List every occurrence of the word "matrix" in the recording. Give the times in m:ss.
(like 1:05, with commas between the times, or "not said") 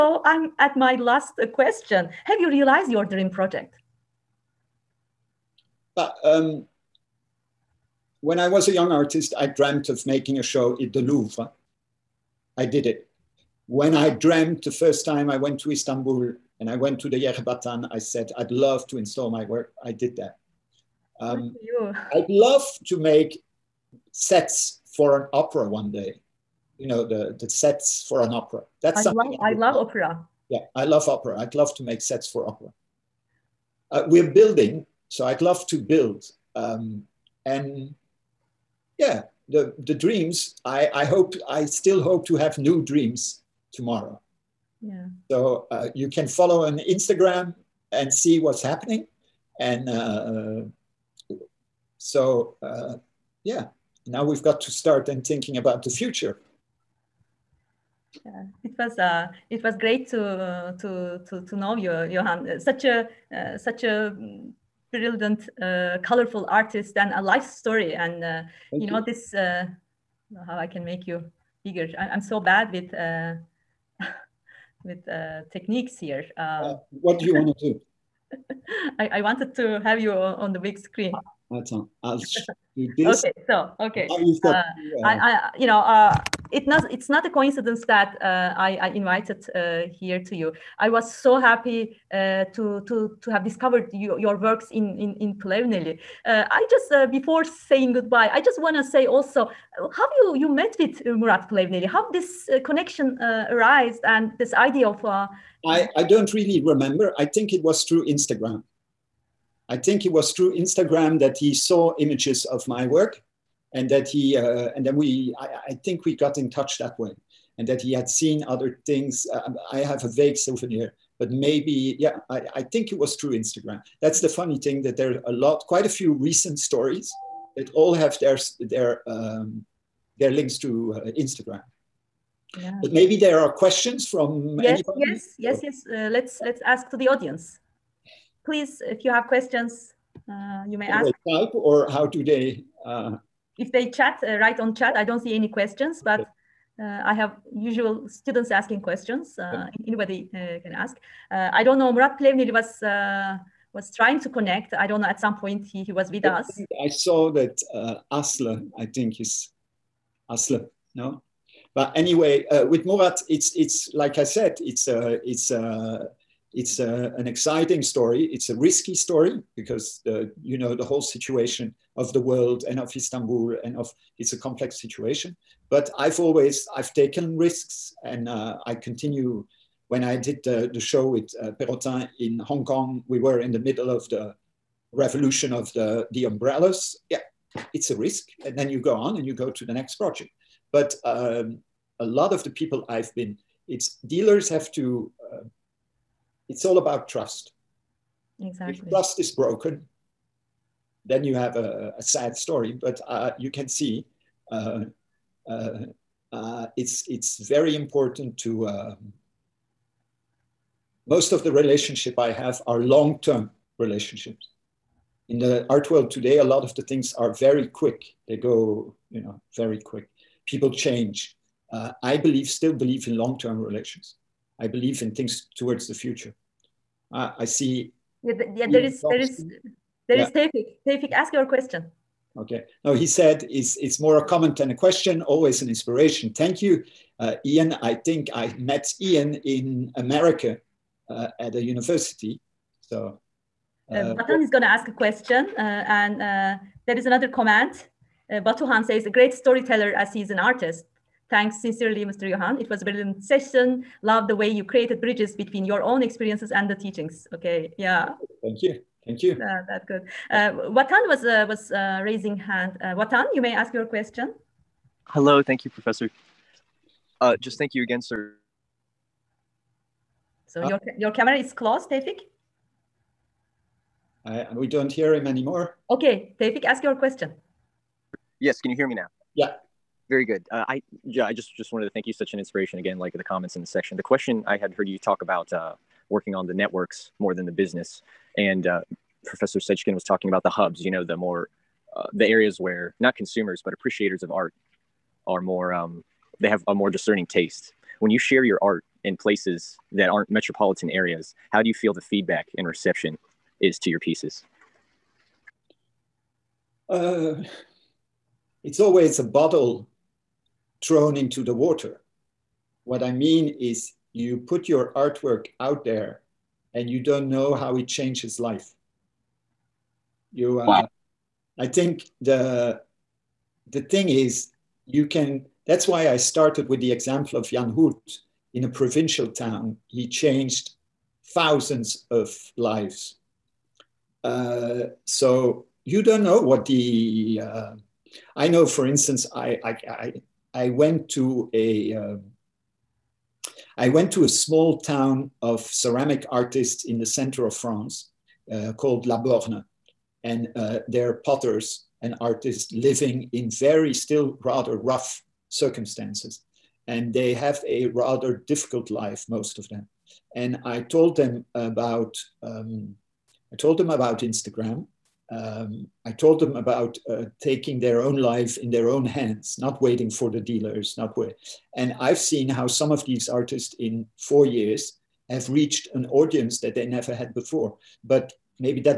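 not said.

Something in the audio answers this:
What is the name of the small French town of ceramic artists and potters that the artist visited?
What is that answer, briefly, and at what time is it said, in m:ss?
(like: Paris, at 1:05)
La Borne, at 5:49.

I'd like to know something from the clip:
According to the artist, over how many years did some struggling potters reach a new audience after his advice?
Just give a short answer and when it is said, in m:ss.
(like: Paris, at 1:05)
4, at 6:14.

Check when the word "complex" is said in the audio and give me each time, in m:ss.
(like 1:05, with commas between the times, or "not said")
2:54.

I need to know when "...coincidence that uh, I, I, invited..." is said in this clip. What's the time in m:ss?
1:27.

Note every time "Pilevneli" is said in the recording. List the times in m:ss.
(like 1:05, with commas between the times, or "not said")
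1:35, 1:41.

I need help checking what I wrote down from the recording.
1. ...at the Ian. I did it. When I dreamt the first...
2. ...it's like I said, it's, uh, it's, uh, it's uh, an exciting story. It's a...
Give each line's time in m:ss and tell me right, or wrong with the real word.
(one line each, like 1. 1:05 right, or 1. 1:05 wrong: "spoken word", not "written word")
1. 0:10 wrong: "Louvre", not "Ian"
2. 2:43 right.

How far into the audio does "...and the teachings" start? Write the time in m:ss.
4:16.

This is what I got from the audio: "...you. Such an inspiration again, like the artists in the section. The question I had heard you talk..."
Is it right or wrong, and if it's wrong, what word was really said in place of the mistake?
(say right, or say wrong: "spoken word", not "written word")
wrong: "comments", not "artists".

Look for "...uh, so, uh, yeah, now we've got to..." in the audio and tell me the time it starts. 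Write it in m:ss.
0:49.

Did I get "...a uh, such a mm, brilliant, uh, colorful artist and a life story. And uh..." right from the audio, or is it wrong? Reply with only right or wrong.
right.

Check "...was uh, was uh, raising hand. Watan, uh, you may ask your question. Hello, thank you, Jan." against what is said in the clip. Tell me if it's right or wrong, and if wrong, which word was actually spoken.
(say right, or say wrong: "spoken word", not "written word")
wrong: "Professor", not "Jan".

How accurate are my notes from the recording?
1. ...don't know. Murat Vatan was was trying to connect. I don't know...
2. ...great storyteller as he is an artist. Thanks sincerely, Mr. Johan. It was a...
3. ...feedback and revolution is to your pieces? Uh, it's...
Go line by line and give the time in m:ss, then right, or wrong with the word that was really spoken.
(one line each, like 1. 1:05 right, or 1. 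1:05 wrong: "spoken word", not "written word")
1. 2:31 wrong: "Plevnil", not "Vatan"
2. 4:09 right
3. 5:02 wrong: "reception", not "revolution".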